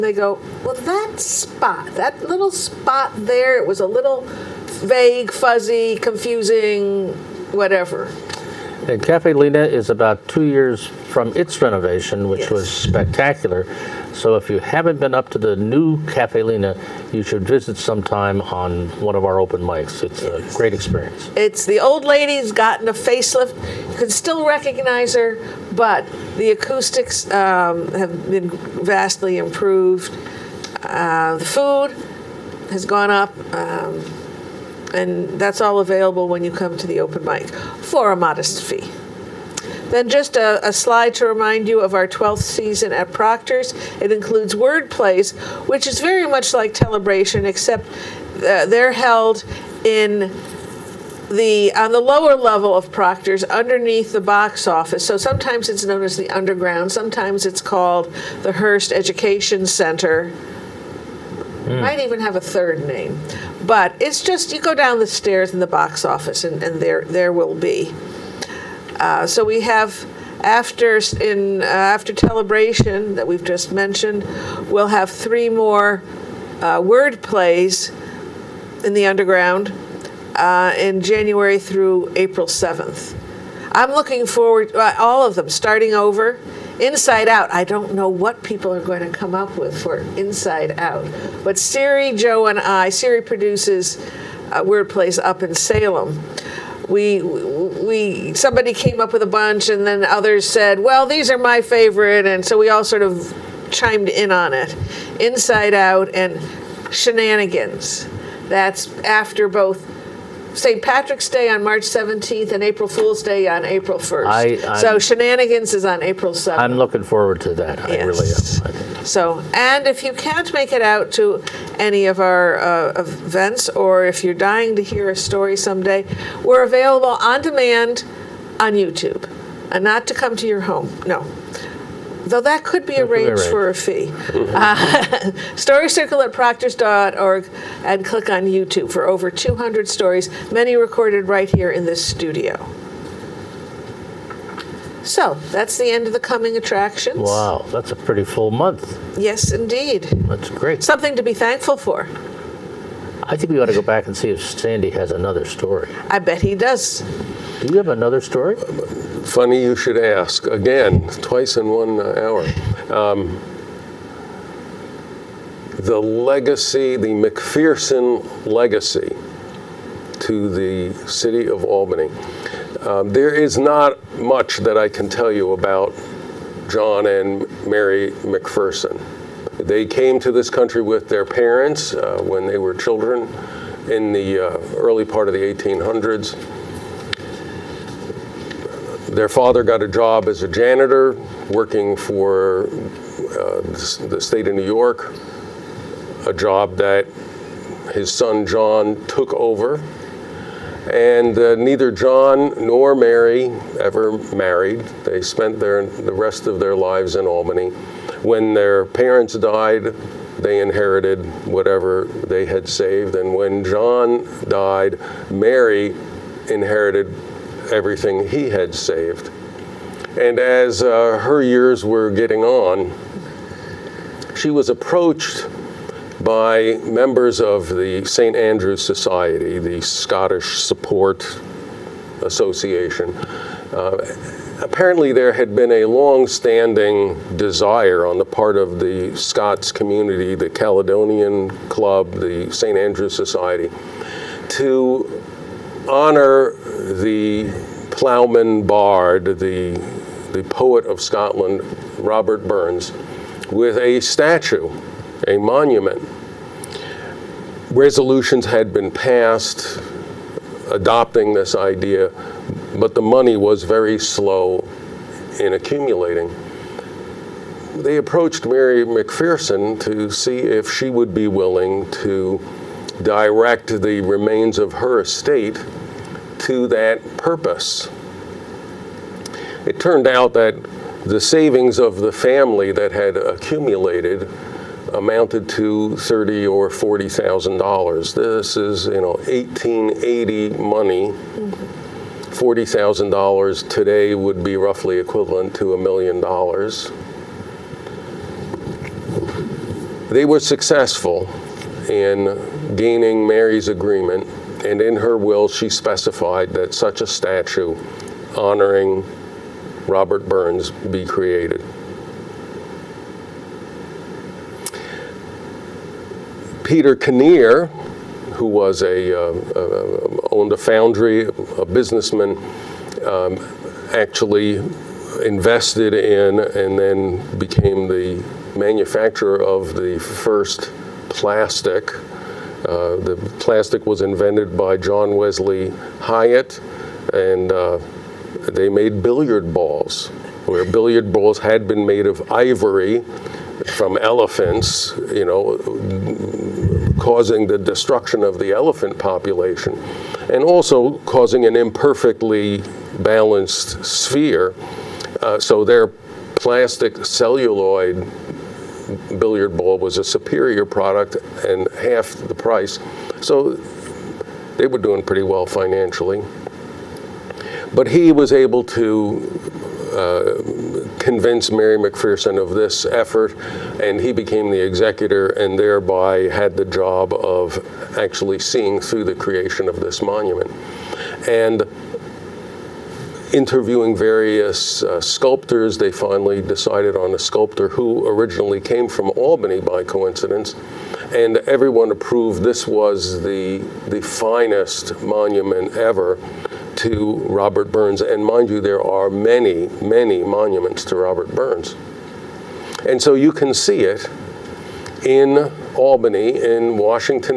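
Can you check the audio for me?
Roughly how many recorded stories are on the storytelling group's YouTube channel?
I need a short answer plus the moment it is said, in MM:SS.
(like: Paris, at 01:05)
over 200, at 02:19.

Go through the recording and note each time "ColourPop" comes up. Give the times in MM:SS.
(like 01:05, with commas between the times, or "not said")
not said.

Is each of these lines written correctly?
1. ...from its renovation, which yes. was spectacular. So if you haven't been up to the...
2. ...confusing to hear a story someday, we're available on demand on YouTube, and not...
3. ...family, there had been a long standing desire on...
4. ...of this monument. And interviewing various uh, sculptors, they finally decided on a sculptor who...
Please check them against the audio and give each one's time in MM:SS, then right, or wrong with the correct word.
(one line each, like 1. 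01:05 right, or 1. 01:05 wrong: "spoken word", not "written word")
1. 00:10 right
2. 02:04 wrong: "dying", not "confusing"
3. 03:54 wrong: "apparently", not "family"
4. 06:19 right.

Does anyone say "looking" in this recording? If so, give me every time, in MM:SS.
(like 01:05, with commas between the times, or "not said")
01:23, 01:56.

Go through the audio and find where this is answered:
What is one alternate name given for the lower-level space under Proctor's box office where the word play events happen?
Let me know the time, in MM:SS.
00:58.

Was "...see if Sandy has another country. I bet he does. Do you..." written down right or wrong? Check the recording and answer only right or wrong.
wrong.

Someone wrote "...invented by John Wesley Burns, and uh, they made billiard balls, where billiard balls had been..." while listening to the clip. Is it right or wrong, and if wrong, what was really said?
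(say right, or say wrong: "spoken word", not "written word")
wrong: "Hyatt", not "Burns".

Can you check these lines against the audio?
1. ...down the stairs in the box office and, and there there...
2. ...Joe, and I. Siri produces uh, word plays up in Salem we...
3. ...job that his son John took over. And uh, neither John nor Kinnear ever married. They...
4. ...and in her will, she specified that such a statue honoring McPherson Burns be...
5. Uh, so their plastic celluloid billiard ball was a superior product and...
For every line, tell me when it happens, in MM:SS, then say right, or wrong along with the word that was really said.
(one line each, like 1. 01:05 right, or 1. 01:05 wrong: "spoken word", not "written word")
1. 01:04 right
2. 01:32 right
3. 03:16 wrong: "Mary", not "Kinnear"
4. 05:04 wrong: "Robert", not "McPherson"
5. 05:55 right.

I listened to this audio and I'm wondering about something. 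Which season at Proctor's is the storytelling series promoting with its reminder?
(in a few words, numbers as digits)
12th.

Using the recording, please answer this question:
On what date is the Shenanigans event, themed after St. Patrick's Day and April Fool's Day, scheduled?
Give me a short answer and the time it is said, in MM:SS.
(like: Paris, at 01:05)
April 7th, at 01:56.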